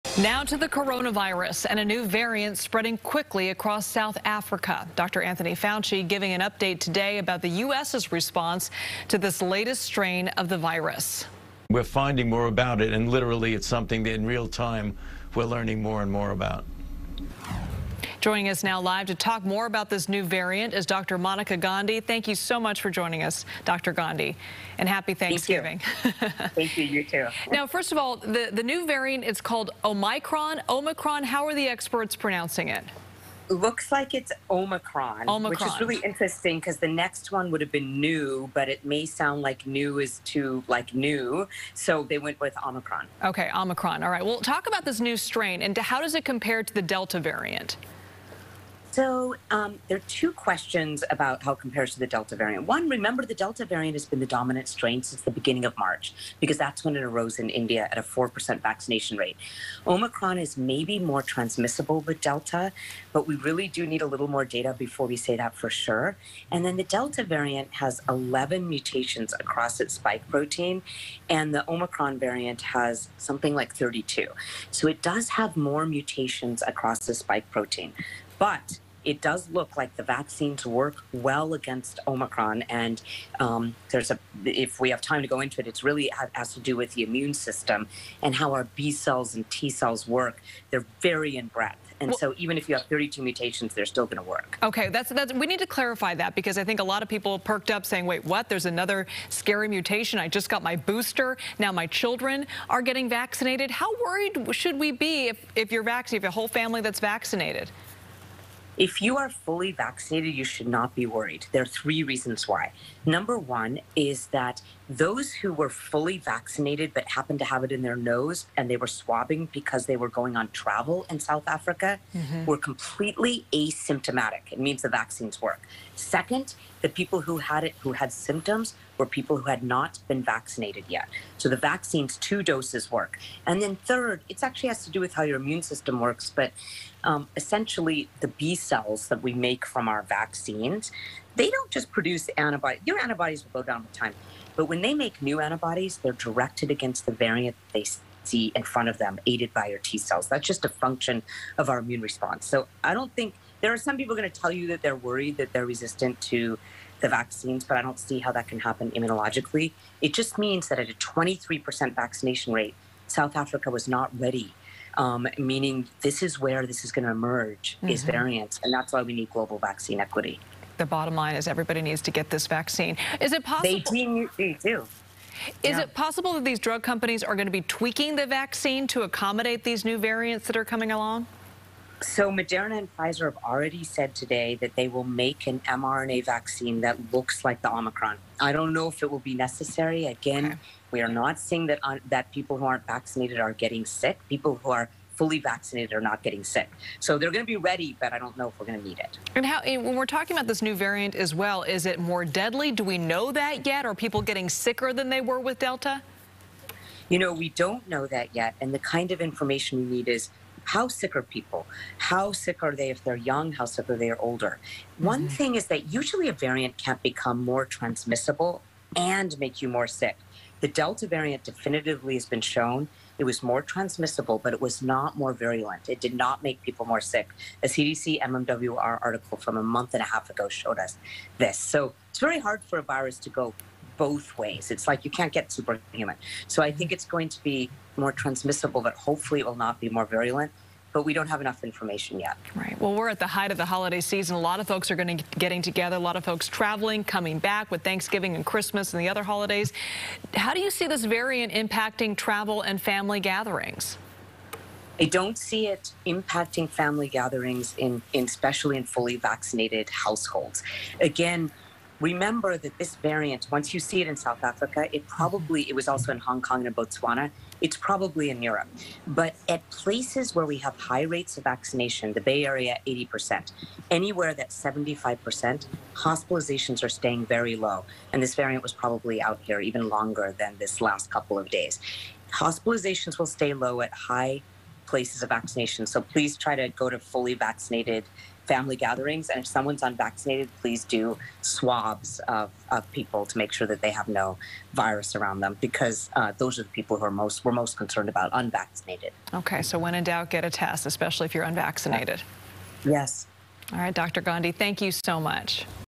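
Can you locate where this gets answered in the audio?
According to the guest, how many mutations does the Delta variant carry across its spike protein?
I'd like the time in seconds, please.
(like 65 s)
68 s.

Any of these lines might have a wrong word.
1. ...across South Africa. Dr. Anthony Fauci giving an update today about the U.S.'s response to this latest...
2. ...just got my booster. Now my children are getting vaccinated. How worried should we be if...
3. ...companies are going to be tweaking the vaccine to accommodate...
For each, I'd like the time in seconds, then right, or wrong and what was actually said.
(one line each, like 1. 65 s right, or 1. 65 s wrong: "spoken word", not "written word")
1. 3 s right
2. 100 s right
3. 176 s right.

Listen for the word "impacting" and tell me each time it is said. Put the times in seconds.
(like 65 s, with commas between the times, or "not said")
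251 s, 256 s.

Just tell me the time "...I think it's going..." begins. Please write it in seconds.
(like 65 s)
236 s.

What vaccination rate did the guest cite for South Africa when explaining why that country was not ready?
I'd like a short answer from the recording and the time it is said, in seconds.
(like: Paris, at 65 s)
23%, at 160 s.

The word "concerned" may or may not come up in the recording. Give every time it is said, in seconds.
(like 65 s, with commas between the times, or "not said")
297 s.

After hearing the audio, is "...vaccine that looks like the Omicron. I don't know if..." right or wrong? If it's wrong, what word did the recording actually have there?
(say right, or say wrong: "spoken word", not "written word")
right.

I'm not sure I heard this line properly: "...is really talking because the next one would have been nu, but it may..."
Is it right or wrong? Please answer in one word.
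wrong.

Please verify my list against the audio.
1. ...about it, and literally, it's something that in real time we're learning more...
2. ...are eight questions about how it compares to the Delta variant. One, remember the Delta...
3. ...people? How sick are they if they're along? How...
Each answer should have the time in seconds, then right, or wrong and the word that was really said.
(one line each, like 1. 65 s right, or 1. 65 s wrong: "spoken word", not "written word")
1. 12 s right
2. 49 s wrong: "two", not "eight"
3. 211 s wrong: "young", not "along".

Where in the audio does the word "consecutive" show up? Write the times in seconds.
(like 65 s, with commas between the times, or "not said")
not said.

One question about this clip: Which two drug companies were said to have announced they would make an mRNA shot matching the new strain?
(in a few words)
Moderna and Pfizer.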